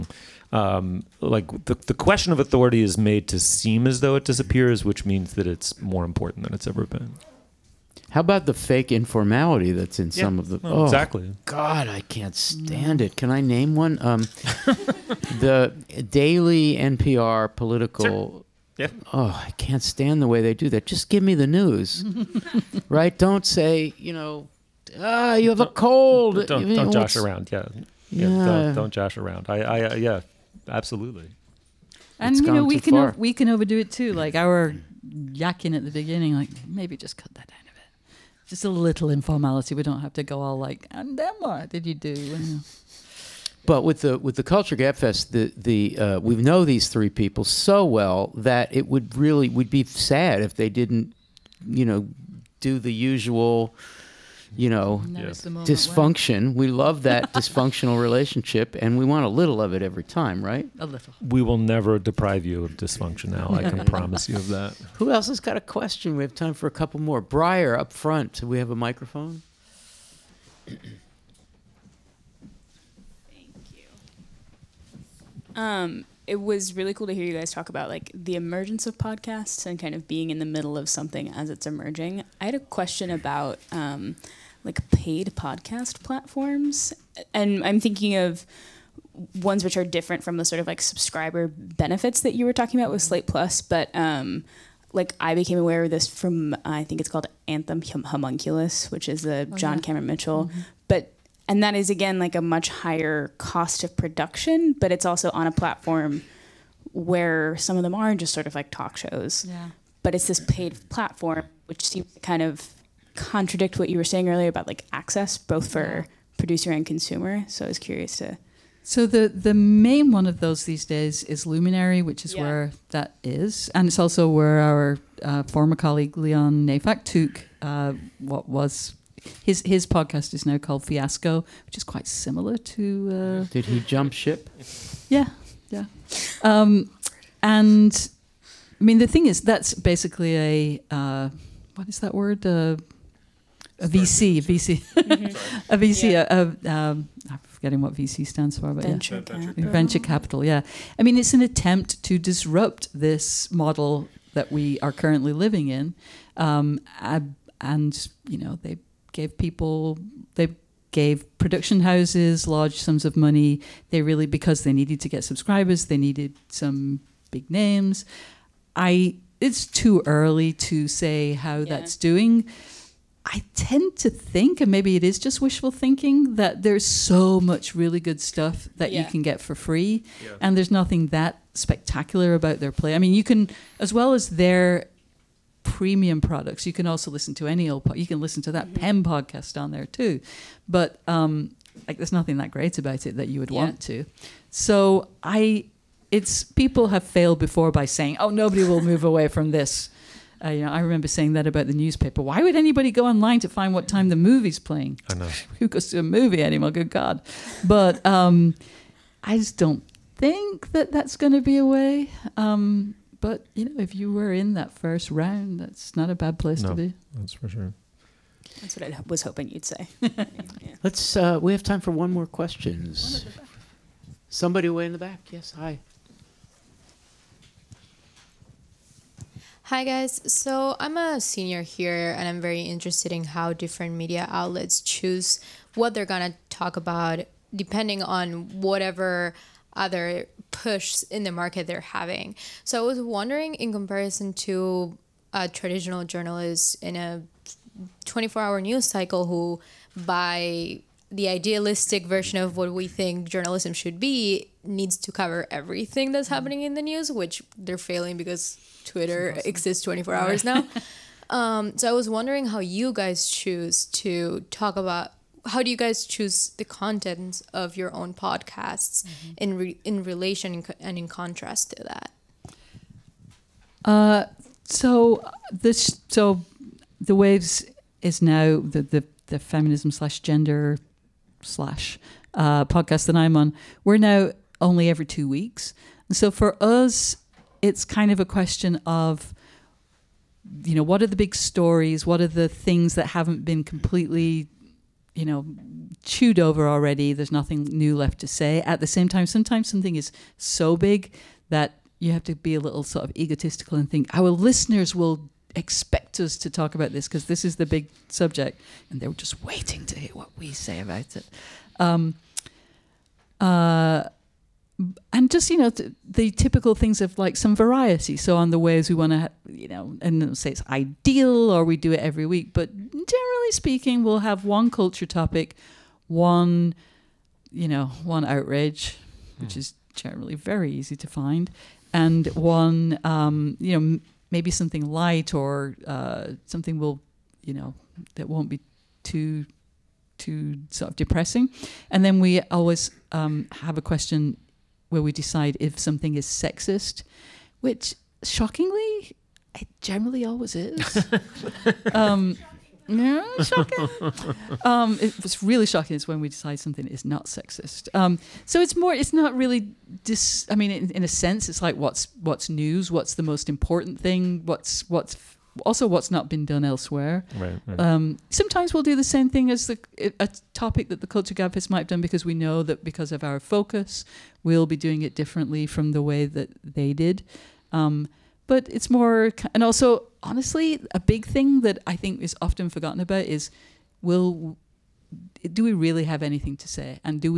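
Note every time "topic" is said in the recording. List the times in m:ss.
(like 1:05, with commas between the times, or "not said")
5:25, 6:10.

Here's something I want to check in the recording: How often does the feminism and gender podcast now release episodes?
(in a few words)
Every two weeks.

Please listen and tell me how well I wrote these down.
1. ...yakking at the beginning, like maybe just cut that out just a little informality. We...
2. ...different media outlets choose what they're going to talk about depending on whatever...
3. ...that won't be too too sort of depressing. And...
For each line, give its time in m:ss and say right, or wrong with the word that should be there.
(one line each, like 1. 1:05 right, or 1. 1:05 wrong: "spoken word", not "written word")
1. 0:35 right
2. 3:53 right
3. 5:38 right.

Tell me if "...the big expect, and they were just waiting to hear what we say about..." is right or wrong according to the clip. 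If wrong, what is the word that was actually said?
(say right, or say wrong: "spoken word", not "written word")
wrong: "subject", not "expect".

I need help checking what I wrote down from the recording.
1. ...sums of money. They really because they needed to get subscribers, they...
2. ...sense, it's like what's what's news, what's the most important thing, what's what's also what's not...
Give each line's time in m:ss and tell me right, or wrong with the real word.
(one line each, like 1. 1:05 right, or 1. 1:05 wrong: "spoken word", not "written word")
1. 2:42 right
2. 6:01 right.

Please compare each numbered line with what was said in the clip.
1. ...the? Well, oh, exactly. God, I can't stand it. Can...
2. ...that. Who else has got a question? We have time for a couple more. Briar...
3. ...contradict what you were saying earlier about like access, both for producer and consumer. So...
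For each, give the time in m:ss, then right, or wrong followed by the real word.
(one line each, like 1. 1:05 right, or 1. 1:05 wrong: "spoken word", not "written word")
1. 0:10 right
2. 1:04 right
3. 1:53 right.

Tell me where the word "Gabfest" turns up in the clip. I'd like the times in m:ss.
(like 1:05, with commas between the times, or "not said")
0:44, 6:11.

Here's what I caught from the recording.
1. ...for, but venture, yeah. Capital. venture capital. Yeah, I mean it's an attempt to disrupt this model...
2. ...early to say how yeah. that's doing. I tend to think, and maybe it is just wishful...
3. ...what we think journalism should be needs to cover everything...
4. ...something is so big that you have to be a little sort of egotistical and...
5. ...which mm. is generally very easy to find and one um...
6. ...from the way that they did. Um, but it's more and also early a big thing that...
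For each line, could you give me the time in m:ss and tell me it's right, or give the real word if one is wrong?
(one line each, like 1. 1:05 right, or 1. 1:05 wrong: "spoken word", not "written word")
1. 2:28 right
2. 2:50 right
3. 4:12 right
4. 4:59 right
5. 5:29 right
6. 6:15 wrong: "honestly", not "early".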